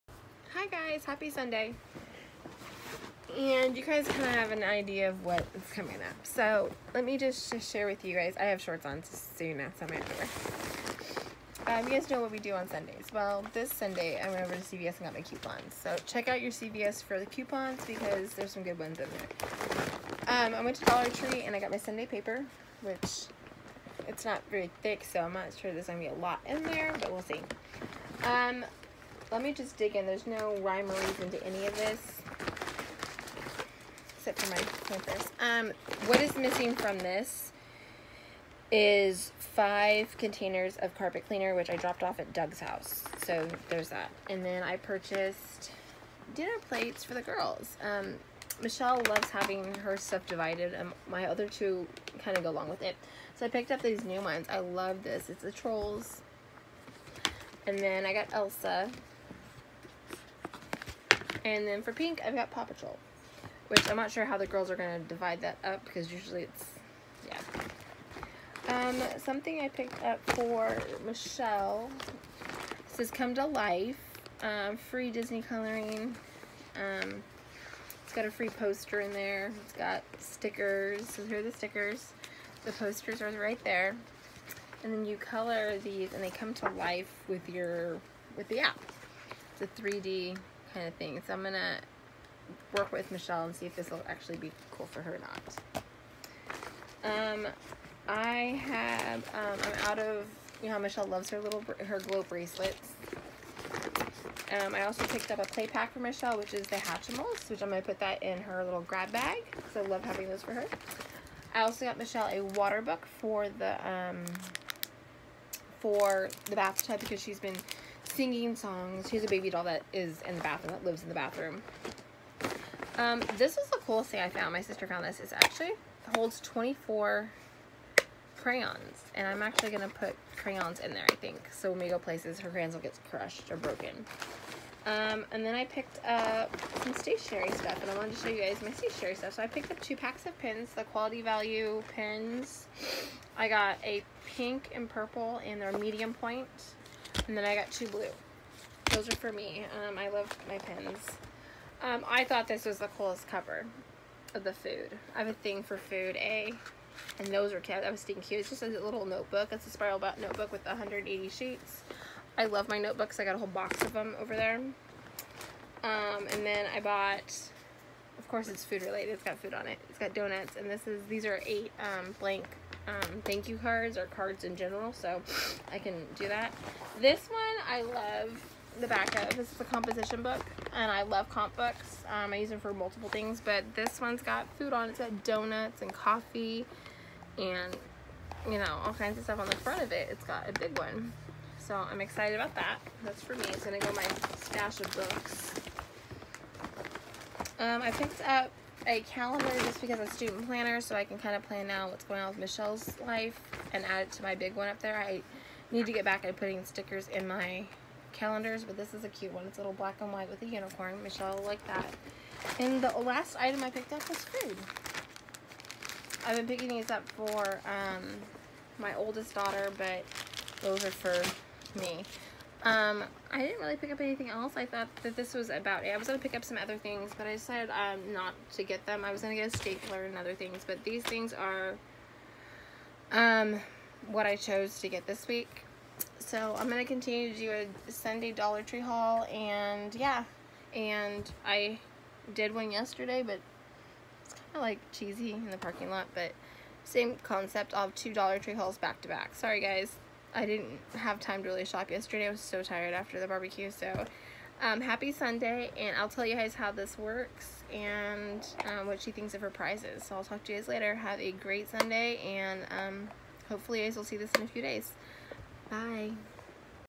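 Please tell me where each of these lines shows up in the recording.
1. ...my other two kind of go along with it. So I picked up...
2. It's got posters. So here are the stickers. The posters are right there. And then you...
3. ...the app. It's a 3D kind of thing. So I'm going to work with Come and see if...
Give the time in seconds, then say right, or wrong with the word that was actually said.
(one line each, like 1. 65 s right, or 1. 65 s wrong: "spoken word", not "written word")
1. 51 s right
2. 79 s wrong: "stickers", not "posters"
3. 88 s wrong: "Michelle", not "Come".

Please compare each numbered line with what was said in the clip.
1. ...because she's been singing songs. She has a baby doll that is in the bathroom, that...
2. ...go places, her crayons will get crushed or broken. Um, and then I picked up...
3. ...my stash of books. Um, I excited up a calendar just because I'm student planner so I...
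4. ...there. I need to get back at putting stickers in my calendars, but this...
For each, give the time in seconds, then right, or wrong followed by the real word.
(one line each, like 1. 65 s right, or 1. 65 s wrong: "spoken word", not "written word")
1. 116 s right
2. 131 s right
3. 193 s wrong: "picked", not "excited"
4. 204 s right.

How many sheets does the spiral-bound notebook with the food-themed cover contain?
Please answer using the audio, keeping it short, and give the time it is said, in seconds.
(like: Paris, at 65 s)
180, at 160 s.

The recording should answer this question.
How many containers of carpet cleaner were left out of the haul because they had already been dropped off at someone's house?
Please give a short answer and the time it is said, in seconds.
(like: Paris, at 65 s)
5, at 39 s.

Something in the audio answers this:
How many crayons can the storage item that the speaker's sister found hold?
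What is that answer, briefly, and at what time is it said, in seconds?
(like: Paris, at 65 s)
24, at 126 s.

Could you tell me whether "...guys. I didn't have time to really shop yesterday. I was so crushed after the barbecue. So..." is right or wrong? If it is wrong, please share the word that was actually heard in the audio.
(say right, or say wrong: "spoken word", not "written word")
wrong: "tired", not "crushed".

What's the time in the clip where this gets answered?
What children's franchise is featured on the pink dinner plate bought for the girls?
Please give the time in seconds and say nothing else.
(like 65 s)
62 s.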